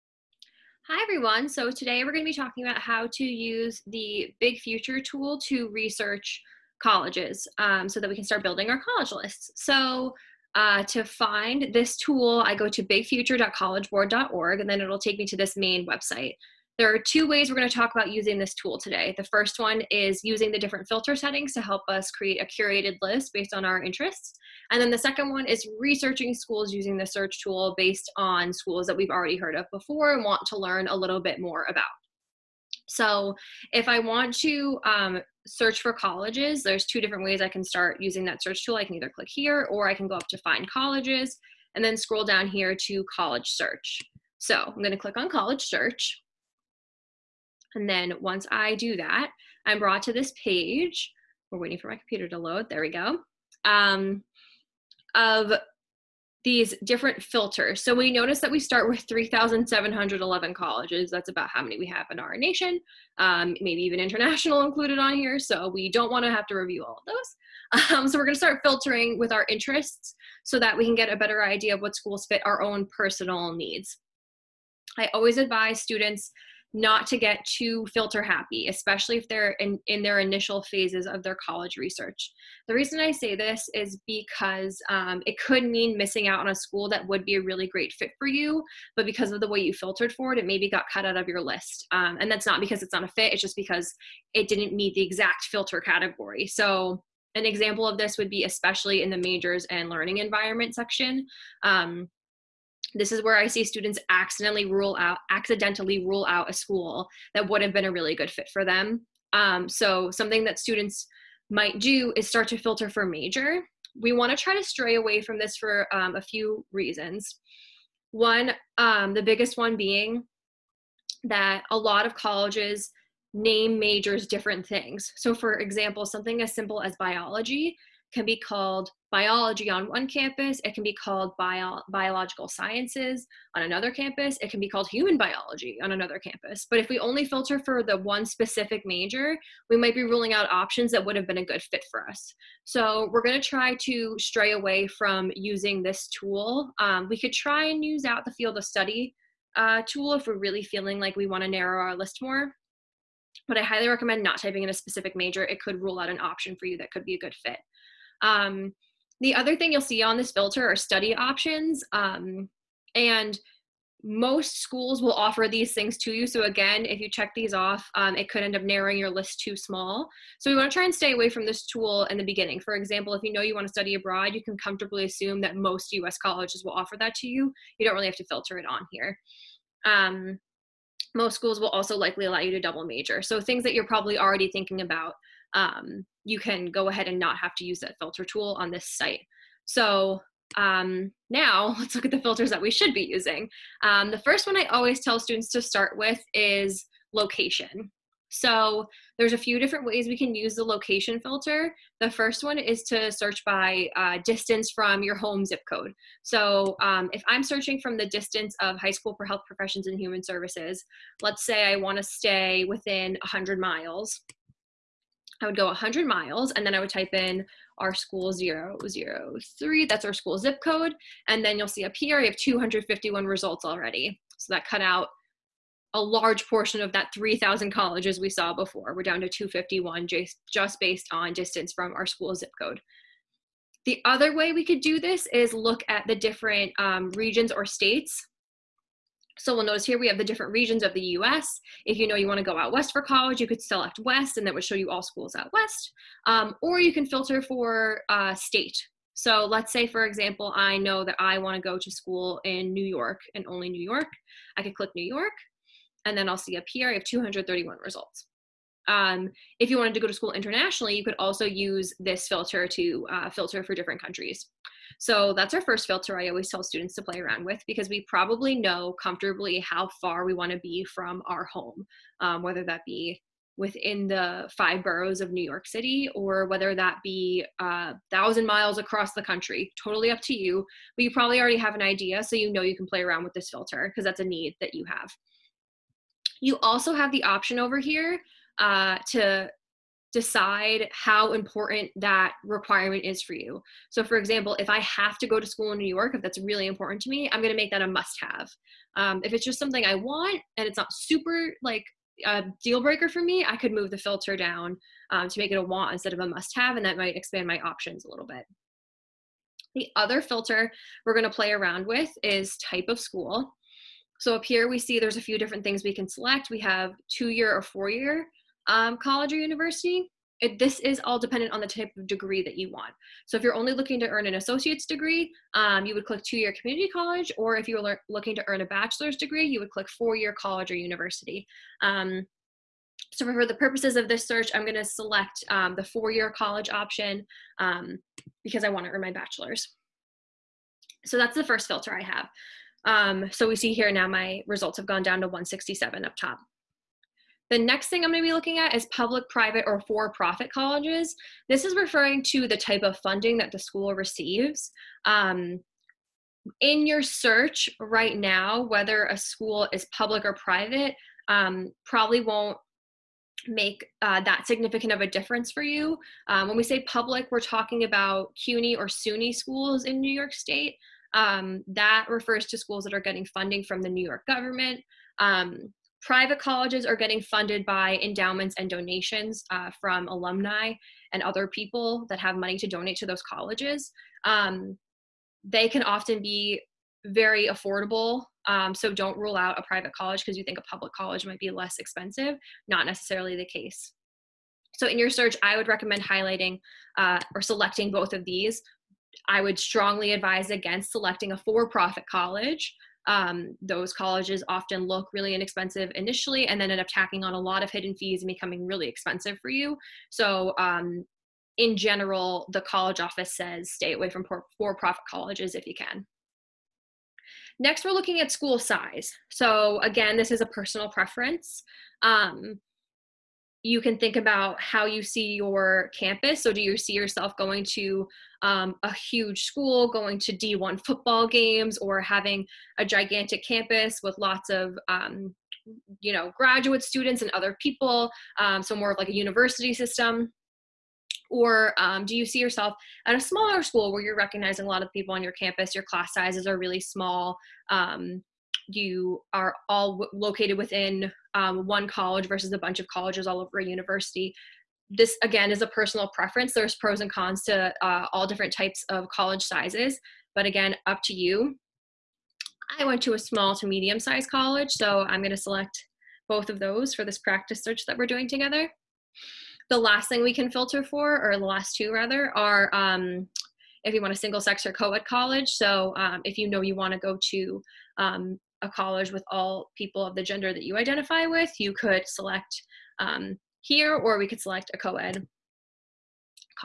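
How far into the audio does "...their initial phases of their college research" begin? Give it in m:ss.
1:20.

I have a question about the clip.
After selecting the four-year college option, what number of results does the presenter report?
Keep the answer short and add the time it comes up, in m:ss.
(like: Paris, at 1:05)
167, at 5:45.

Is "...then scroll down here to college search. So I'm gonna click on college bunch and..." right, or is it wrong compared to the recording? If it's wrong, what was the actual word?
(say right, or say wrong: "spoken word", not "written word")
wrong: "search", not "bunch".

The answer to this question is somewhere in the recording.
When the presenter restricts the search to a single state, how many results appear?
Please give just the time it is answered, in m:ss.
4:17.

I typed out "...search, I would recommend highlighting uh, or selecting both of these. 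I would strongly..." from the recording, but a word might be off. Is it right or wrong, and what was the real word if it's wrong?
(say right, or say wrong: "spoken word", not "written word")
right.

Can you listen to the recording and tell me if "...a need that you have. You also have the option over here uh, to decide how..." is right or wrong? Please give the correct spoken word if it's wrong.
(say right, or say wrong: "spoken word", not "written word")
right.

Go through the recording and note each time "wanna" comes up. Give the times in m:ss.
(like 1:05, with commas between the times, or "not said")
4:02, 4:11, 5:38.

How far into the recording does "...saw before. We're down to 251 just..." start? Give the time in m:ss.
3:48.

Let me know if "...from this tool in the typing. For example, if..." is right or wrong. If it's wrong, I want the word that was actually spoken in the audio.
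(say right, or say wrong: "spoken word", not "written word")
wrong: "beginning", not "typing".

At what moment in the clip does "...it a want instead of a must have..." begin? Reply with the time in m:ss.
5:05.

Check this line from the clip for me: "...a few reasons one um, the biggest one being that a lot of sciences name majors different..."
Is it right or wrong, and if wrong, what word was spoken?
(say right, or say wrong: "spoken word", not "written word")
wrong: "colleges", not "sciences".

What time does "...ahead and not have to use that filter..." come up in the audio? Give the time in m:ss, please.
3:06.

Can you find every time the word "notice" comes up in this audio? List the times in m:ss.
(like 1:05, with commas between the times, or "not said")
0:58, 3:59.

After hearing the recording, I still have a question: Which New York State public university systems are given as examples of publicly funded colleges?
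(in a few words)
CUNY or SUNY.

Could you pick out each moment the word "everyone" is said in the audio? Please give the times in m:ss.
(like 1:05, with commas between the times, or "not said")
0:01.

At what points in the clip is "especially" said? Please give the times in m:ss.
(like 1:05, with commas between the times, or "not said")
1:18, 1:38.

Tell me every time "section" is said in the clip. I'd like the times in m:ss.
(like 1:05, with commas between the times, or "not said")
1:40.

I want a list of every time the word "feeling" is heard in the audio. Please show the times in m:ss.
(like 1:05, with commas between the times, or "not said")
2:30.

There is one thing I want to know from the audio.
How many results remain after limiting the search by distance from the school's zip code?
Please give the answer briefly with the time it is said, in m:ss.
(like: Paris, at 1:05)
251, at 3:42.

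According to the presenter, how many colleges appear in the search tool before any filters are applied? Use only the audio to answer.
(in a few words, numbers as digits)
3,711.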